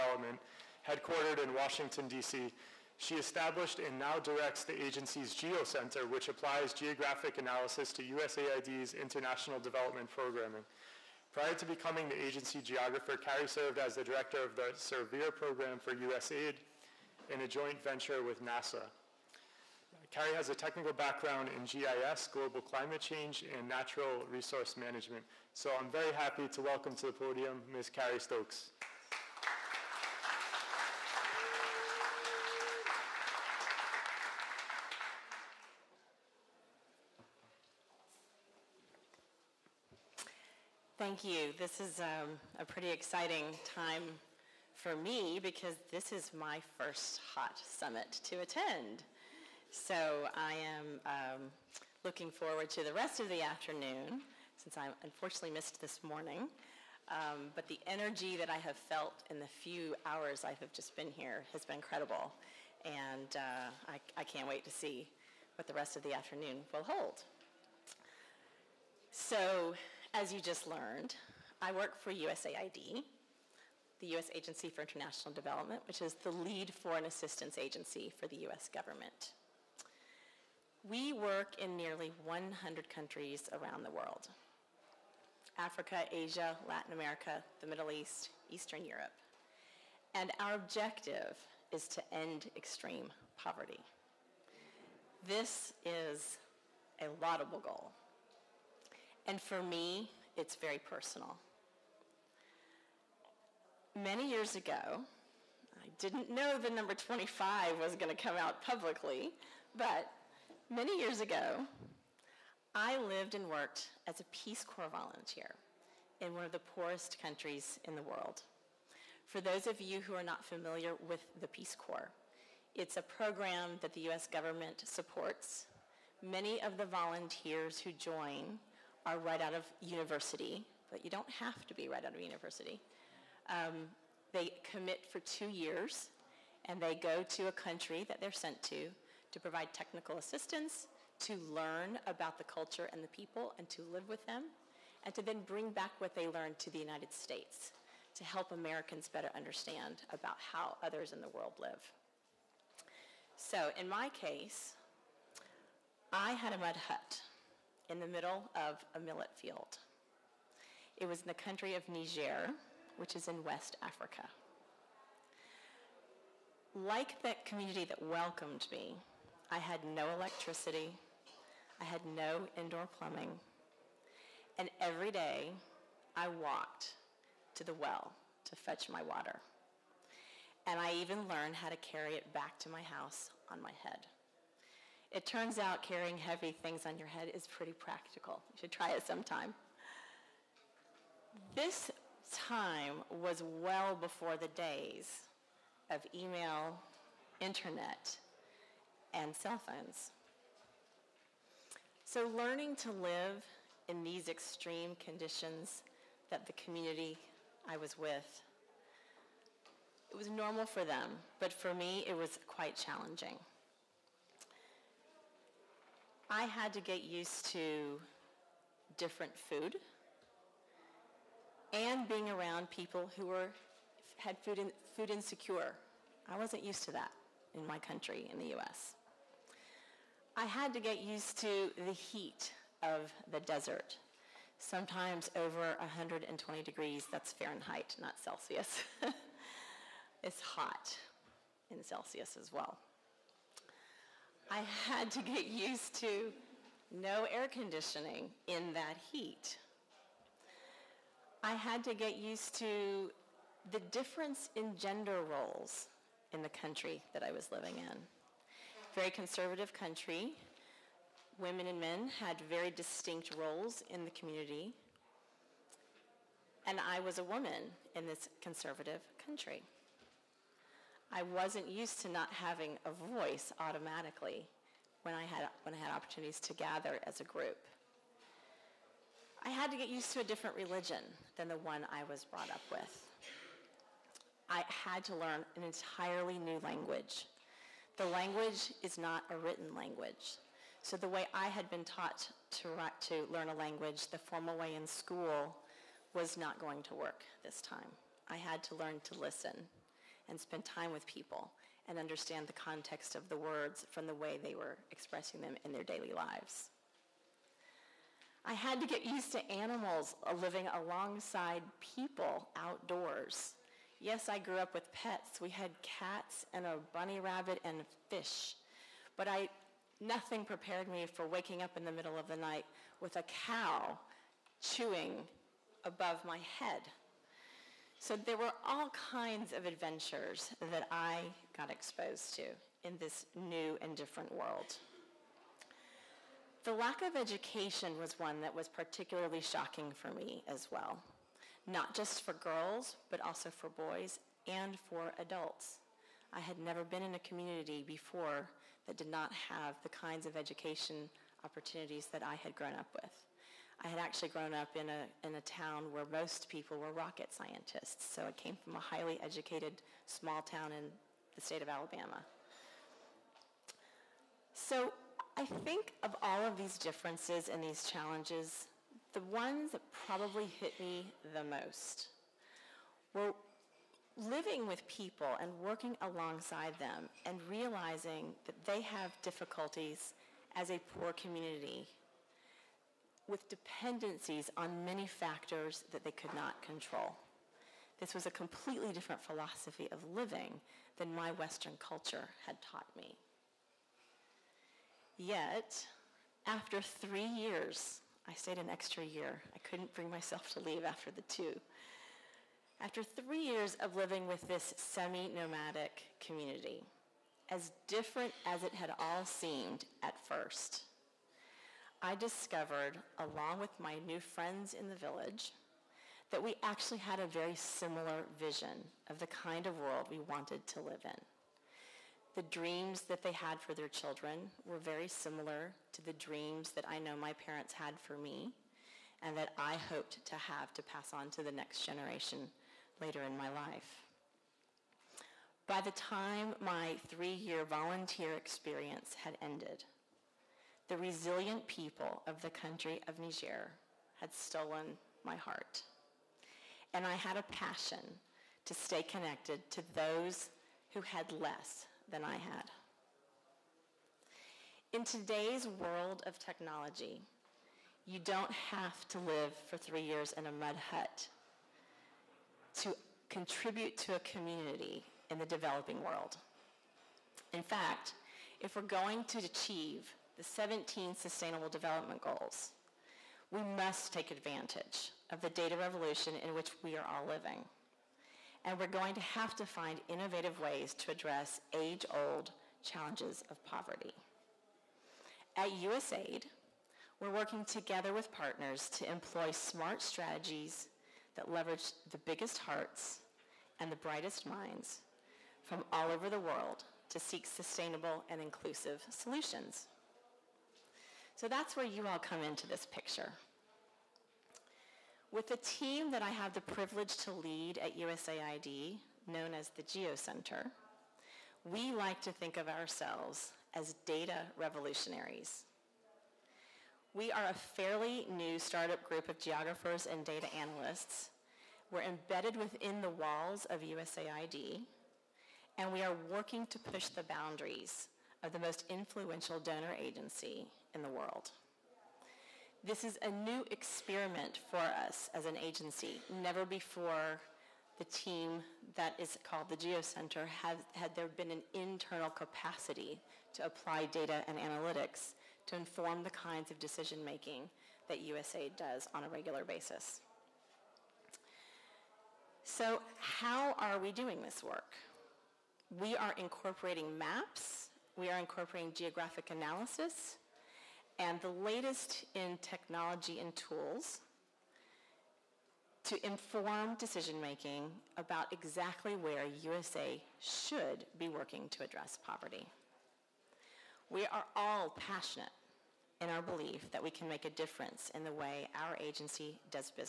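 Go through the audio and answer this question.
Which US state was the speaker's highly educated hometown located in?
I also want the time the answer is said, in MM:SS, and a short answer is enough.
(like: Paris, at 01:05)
Alabama, at 06:01.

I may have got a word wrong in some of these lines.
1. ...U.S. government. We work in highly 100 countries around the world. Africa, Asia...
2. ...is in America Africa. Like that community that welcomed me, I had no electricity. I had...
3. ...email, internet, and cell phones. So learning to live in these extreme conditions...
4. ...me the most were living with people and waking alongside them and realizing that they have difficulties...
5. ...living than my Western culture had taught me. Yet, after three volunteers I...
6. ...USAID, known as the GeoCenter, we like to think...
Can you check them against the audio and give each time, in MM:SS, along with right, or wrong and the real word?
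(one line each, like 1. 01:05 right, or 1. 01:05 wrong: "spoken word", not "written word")
1. 01:18 wrong: "nearly", not "highly"
2. 02:43 wrong: "West", not "America"
3. 03:16 right
4. 06:10 wrong: "working", not "waking"
5. 06:30 wrong: "years", not "volunteers"
6. 08:27 right.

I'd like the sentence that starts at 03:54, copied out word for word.
Sometimes over 120 degrees, that's Fahrenheit, not Celsius.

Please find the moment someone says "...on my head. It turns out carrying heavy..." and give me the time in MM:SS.
03:03.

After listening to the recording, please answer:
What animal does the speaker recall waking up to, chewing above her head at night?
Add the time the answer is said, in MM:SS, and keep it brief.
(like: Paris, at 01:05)
A cow, at 05:23.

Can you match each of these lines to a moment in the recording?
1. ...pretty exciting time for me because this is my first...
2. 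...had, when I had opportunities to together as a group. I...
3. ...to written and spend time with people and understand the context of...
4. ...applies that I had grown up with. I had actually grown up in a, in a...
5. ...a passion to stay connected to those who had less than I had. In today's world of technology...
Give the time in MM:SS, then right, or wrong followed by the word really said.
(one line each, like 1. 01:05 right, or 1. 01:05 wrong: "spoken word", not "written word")
1. 00:42 right
2. 04:35 wrong: "gather", not "together"
3. 04:59 wrong: "listen", not "written"
4. 05:51 wrong: "opportunities", not "applies"
5. 07:27 right.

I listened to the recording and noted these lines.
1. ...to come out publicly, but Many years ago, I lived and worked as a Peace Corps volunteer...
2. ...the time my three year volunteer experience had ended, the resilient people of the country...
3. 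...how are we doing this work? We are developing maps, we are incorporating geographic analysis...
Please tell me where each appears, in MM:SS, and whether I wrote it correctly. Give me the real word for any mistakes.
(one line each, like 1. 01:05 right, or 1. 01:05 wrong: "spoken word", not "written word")
1. 01:48 right
2. 07:15 right
3. 09:13 wrong: "incorporating", not "developing".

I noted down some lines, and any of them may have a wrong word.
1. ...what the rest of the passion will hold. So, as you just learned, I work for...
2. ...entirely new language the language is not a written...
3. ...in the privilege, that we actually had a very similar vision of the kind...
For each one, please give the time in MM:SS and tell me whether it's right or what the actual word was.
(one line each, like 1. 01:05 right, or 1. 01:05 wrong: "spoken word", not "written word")
1. 01:05 wrong: "afternoon", not "passion"
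2. 04:45 right
3. 06:54 wrong: "village", not "privilege".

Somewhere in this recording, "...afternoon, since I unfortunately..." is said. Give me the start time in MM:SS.
00:53.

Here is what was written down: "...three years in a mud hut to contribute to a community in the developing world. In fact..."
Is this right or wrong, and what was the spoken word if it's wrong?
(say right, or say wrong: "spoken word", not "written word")
right.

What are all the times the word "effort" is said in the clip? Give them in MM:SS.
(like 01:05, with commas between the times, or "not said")
not said.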